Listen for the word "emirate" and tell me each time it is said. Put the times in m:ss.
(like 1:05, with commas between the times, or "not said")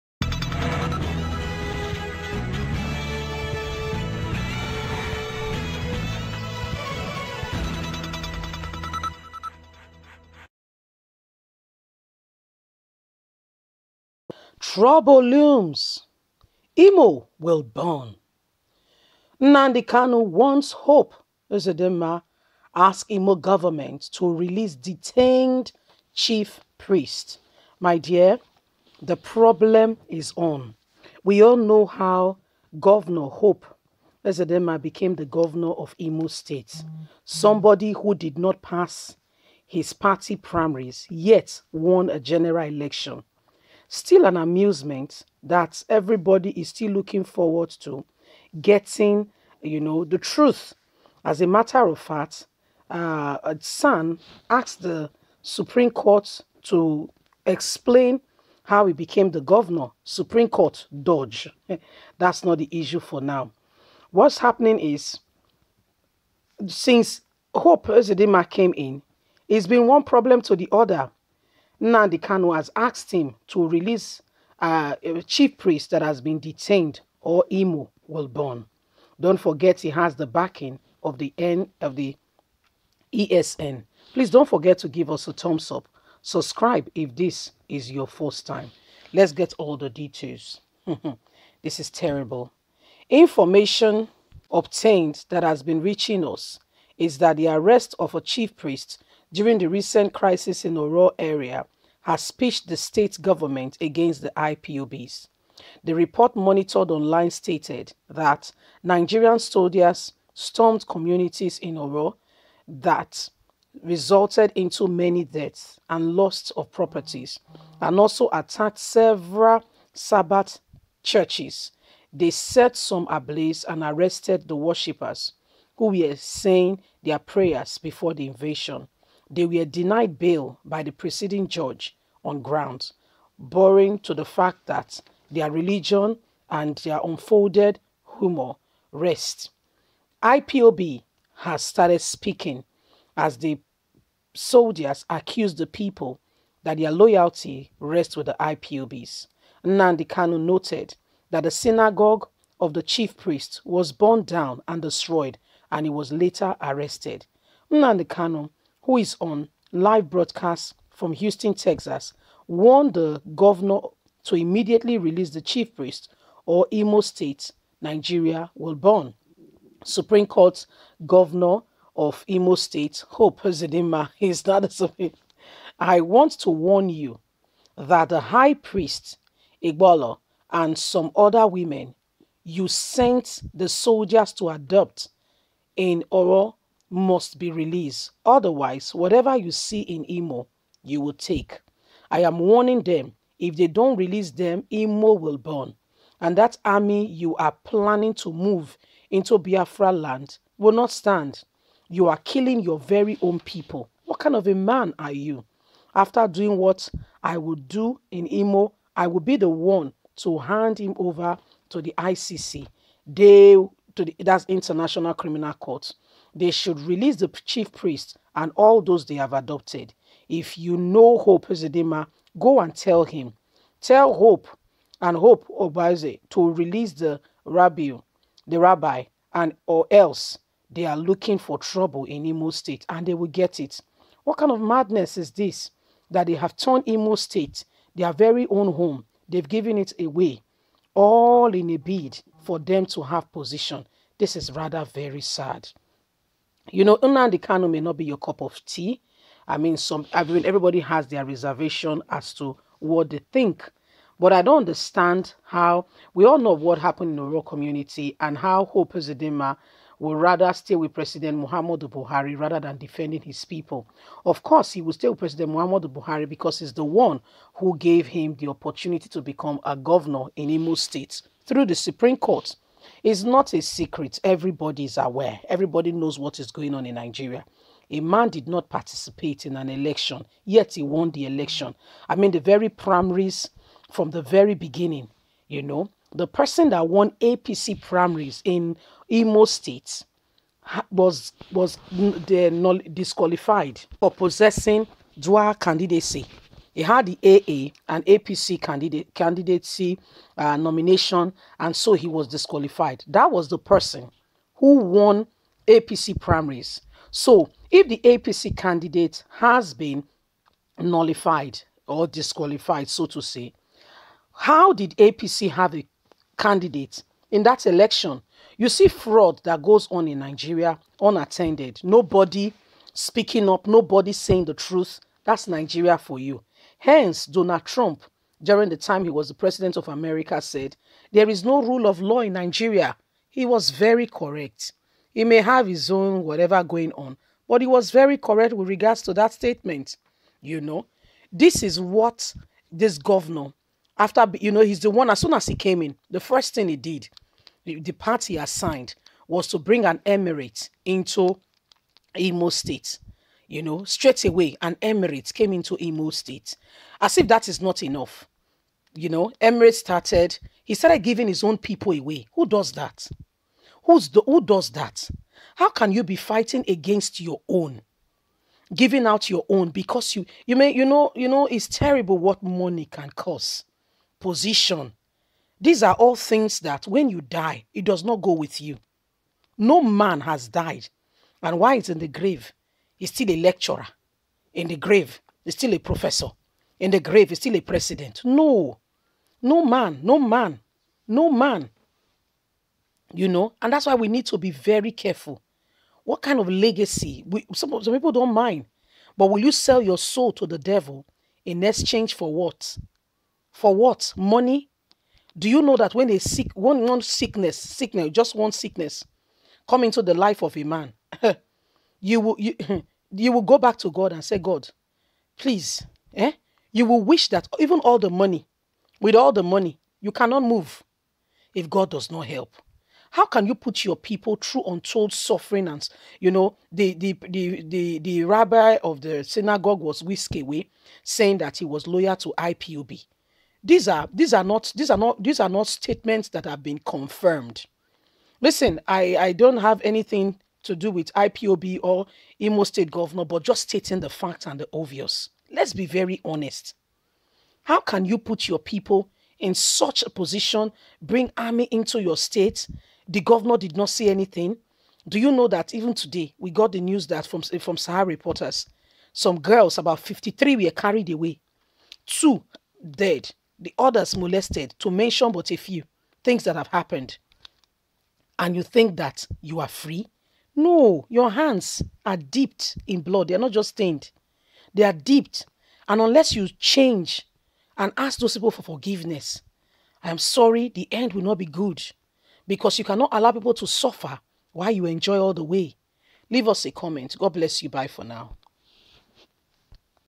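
5:50, 5:54, 5:59.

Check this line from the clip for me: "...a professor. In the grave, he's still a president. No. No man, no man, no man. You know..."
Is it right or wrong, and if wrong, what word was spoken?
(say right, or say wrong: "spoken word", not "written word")
right.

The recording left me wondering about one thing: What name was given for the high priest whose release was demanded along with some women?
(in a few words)
Igbolo.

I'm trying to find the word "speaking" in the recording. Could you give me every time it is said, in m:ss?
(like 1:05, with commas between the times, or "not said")
2:22, 5:22.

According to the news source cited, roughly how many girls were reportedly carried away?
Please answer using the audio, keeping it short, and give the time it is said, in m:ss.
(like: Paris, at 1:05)
53, at 7:39.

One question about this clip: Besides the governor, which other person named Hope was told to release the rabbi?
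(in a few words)
Hope Obaze.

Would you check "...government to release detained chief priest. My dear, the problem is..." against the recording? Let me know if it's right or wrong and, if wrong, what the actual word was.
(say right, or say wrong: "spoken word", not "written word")
right.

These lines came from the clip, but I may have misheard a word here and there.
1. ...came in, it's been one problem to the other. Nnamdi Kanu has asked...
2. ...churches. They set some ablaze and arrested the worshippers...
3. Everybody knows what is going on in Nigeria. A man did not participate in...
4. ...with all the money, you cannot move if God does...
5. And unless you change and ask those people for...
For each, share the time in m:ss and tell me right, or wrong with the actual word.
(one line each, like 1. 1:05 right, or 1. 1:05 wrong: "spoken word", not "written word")
1. 1:08 right
2. 2:01 right
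3. 4:35 right
4. 6:59 right
5. 7:55 right.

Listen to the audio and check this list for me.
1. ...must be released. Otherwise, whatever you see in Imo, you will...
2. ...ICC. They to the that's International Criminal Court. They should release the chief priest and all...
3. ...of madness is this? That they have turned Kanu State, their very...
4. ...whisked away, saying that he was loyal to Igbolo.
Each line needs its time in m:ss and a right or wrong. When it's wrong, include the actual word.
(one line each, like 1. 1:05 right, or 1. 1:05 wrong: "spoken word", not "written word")
1. 3:06 right
2. 3:31 right
3. 3:54 wrong: "Imo", not "Kanu"
4. 7:10 wrong: "IPOB", not "Igbolo".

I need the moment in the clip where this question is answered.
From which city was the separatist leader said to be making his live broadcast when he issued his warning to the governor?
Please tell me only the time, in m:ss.
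2:41.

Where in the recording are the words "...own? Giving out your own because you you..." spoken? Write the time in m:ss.
6:07.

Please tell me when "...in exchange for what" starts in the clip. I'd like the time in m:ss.
6:41.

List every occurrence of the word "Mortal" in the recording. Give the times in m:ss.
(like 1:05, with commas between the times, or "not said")
not said.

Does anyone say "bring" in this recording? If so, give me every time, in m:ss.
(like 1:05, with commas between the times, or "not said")
5:49, 7:31.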